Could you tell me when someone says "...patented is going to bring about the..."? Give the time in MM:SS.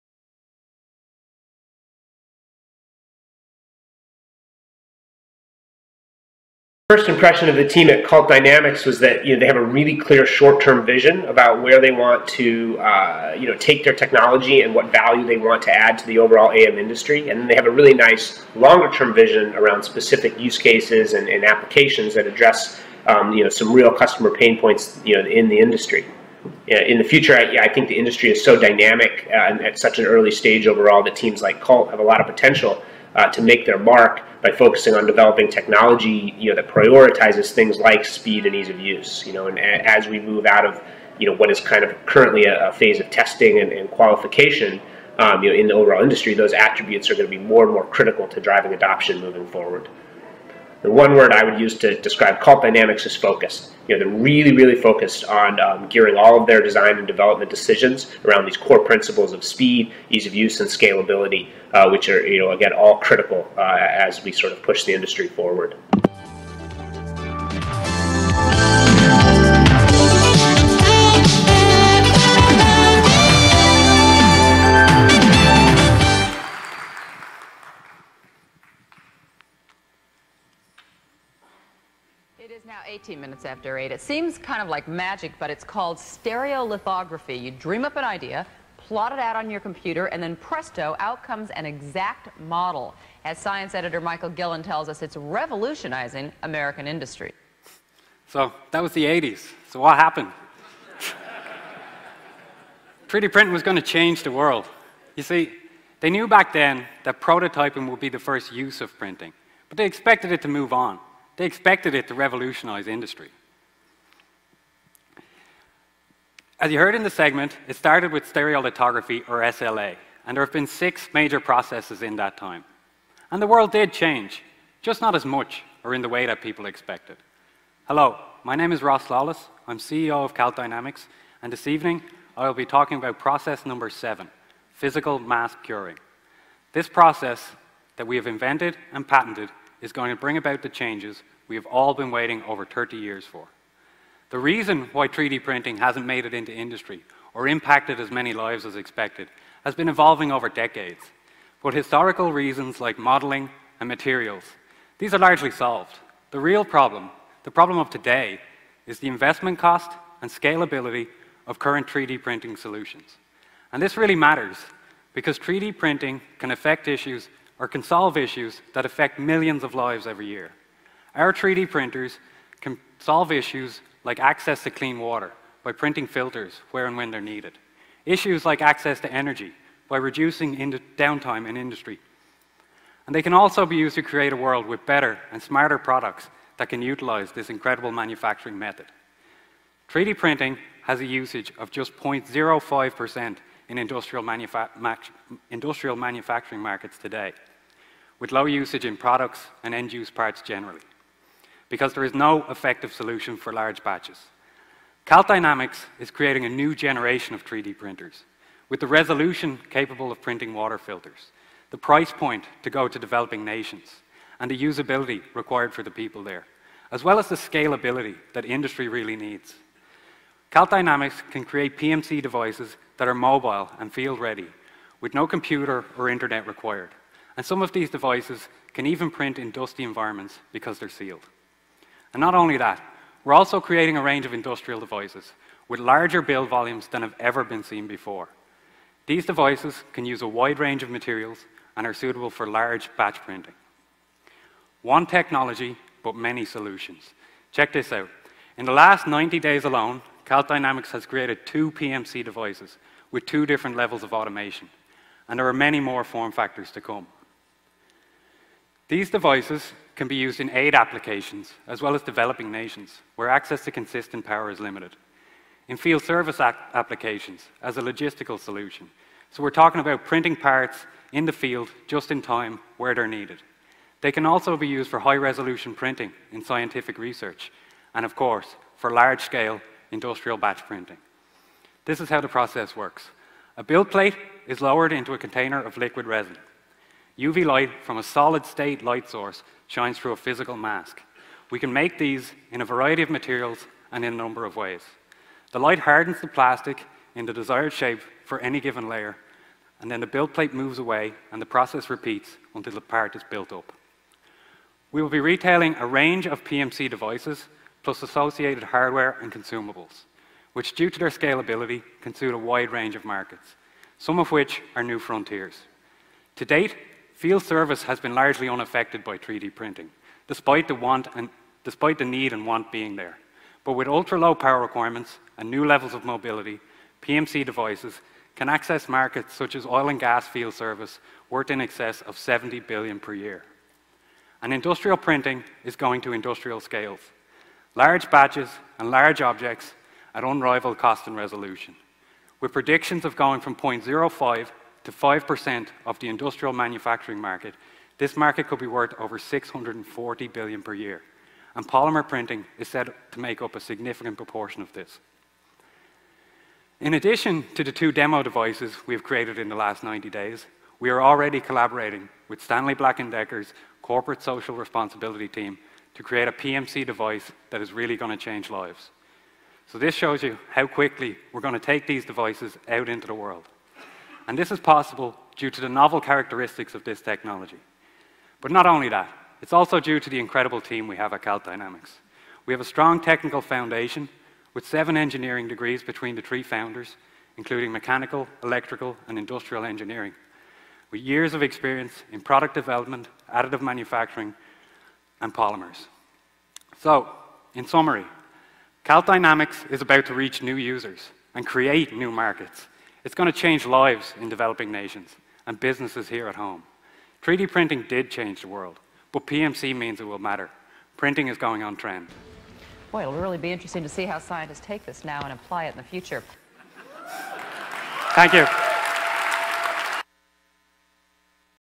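02:19.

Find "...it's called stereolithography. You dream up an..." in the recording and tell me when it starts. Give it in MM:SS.
01:25.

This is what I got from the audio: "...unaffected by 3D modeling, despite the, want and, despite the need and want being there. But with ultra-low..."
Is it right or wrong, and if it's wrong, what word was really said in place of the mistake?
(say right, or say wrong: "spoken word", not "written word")
wrong: "printing", not "modeling".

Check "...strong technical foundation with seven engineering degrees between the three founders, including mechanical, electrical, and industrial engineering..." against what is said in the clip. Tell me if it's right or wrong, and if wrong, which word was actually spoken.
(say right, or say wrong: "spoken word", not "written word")
right.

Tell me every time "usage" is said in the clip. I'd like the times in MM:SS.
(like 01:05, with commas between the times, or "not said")
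03:11, 03:18.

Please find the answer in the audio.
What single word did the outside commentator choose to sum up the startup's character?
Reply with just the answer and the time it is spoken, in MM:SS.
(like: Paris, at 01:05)
Focus, at 00:53.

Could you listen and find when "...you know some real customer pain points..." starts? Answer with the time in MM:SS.
00:23.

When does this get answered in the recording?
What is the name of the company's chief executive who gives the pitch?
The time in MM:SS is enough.
02:08.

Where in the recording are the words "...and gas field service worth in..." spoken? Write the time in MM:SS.
05:29.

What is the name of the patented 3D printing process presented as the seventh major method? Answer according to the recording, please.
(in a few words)
Physical mask curing.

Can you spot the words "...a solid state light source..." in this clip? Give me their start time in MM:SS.
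04:47.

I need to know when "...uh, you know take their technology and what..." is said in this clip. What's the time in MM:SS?
00:12.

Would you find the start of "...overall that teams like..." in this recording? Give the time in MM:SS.
00:30.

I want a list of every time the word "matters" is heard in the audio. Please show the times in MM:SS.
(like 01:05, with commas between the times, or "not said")
02:44, 06:50.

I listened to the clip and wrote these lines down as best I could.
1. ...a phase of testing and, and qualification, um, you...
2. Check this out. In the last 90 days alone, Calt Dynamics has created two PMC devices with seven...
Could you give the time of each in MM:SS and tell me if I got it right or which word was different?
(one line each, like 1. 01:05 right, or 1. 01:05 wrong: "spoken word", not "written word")
1. 00:42 right
2. 04:07 wrong: "two", not "seven".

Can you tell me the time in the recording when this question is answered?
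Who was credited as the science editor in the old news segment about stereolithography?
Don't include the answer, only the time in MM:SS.
01:34.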